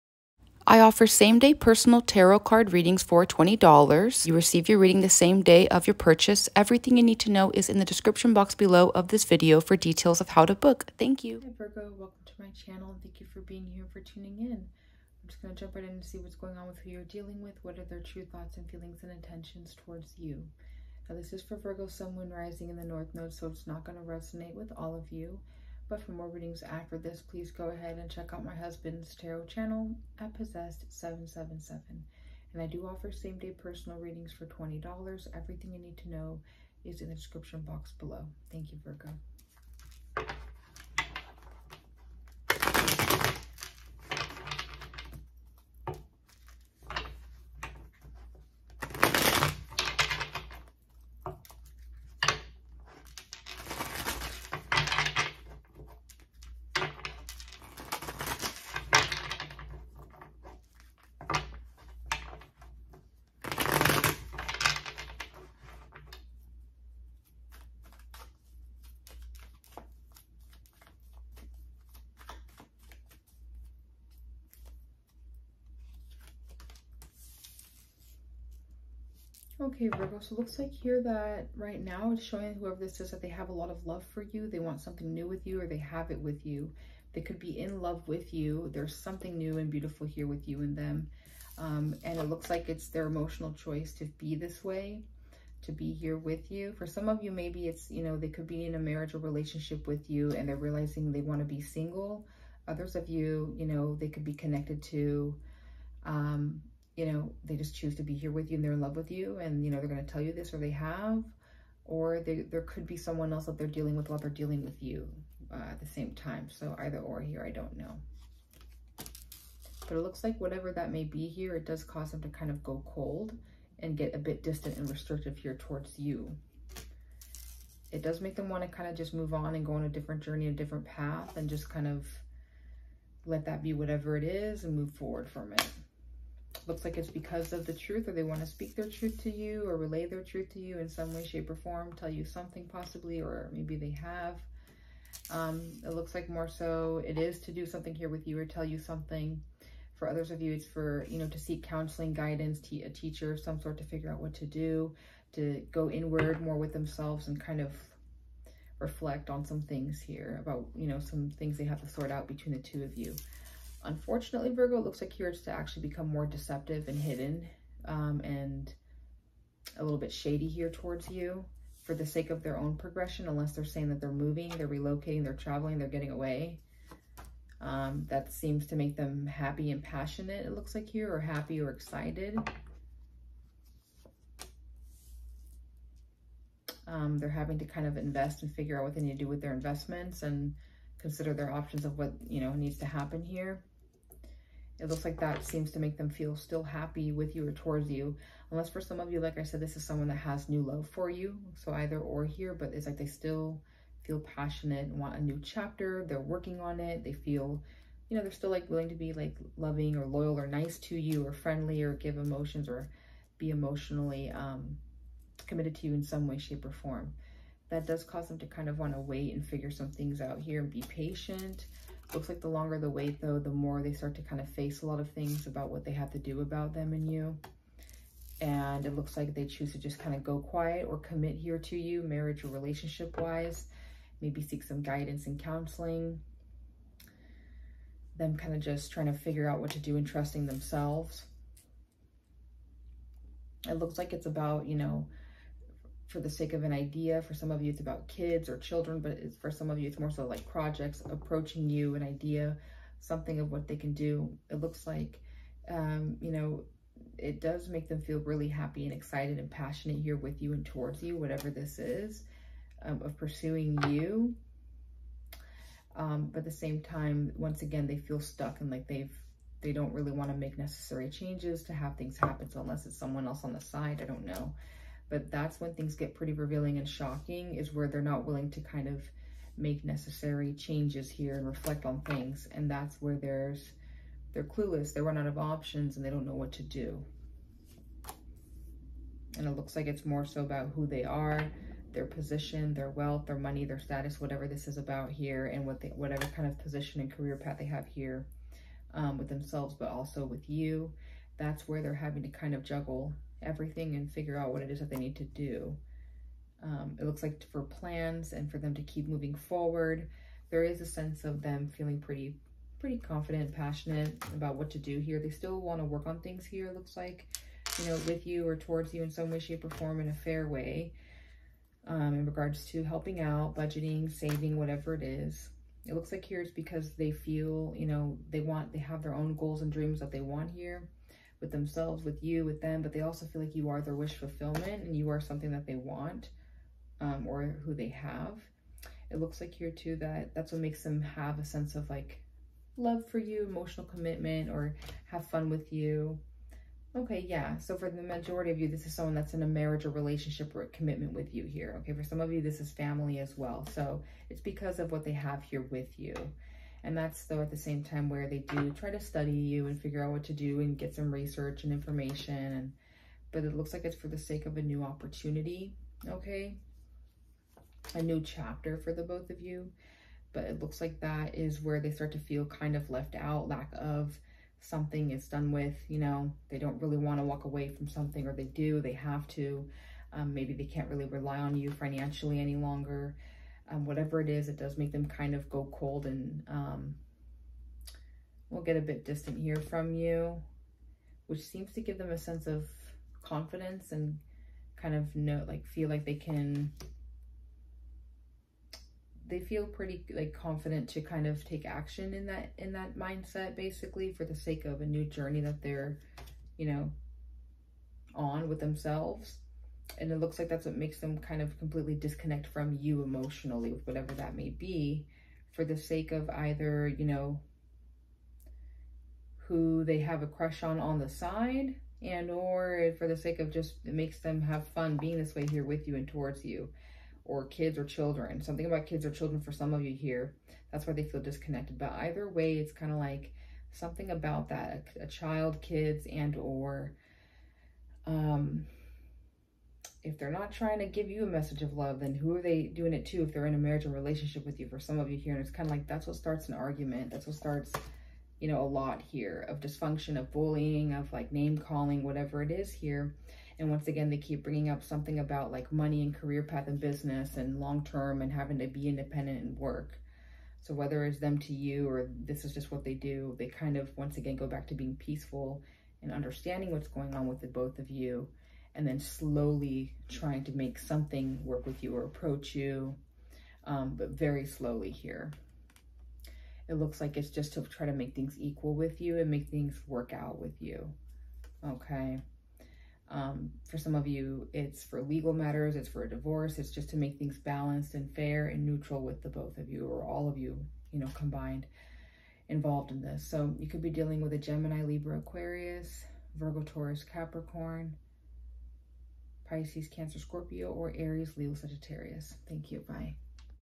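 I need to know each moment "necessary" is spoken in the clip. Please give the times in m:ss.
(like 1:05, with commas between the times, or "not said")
4:30, 4:39.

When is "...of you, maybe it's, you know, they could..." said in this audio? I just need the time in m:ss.
1:37.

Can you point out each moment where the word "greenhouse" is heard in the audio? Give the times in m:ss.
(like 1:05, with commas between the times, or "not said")
not said.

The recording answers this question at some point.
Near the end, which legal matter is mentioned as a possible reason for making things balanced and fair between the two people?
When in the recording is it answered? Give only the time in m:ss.
8:06.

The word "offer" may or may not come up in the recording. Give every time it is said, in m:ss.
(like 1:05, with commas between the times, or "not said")
0:00, 0:32.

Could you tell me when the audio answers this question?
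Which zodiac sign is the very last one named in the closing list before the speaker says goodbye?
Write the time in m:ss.
8:21.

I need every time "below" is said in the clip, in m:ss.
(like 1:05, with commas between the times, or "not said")
0:08, 0:37.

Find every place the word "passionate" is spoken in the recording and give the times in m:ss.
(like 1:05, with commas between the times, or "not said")
2:59, 3:24, 4:19, 5:13.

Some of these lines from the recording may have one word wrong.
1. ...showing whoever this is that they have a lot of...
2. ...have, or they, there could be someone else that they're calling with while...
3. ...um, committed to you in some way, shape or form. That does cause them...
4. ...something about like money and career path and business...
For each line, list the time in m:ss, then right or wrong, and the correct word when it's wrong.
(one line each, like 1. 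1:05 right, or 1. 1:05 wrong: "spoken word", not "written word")
1. 1:22 right
2. 1:50 wrong: "dealing", not "calling"
3. 3:34 right
4. 7:34 right.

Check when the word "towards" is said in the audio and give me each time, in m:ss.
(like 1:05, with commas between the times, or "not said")
0:19, 2:05, 2:50, 3:17, 4:20, 5:18, 7:06.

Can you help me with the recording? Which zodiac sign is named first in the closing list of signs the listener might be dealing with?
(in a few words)
Gemini.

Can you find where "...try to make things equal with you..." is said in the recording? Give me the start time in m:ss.
7:57.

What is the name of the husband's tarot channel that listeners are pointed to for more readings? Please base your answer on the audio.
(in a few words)
Possessed777.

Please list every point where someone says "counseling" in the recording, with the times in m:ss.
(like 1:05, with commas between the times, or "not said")
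2:31, 3:55.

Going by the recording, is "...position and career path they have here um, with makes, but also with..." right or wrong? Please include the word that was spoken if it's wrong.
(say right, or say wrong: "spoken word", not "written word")
wrong: "themselves", not "makes".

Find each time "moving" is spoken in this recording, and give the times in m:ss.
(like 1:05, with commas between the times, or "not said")
2:54, 5:09.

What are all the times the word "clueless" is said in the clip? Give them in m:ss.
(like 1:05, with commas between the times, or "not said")
4:44.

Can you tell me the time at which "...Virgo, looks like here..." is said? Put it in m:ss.
2:44.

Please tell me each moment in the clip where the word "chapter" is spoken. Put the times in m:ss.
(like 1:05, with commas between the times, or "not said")
3:25, 6:08.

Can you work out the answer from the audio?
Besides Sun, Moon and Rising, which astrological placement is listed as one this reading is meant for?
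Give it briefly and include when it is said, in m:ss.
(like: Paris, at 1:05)
North Node, at 0:22.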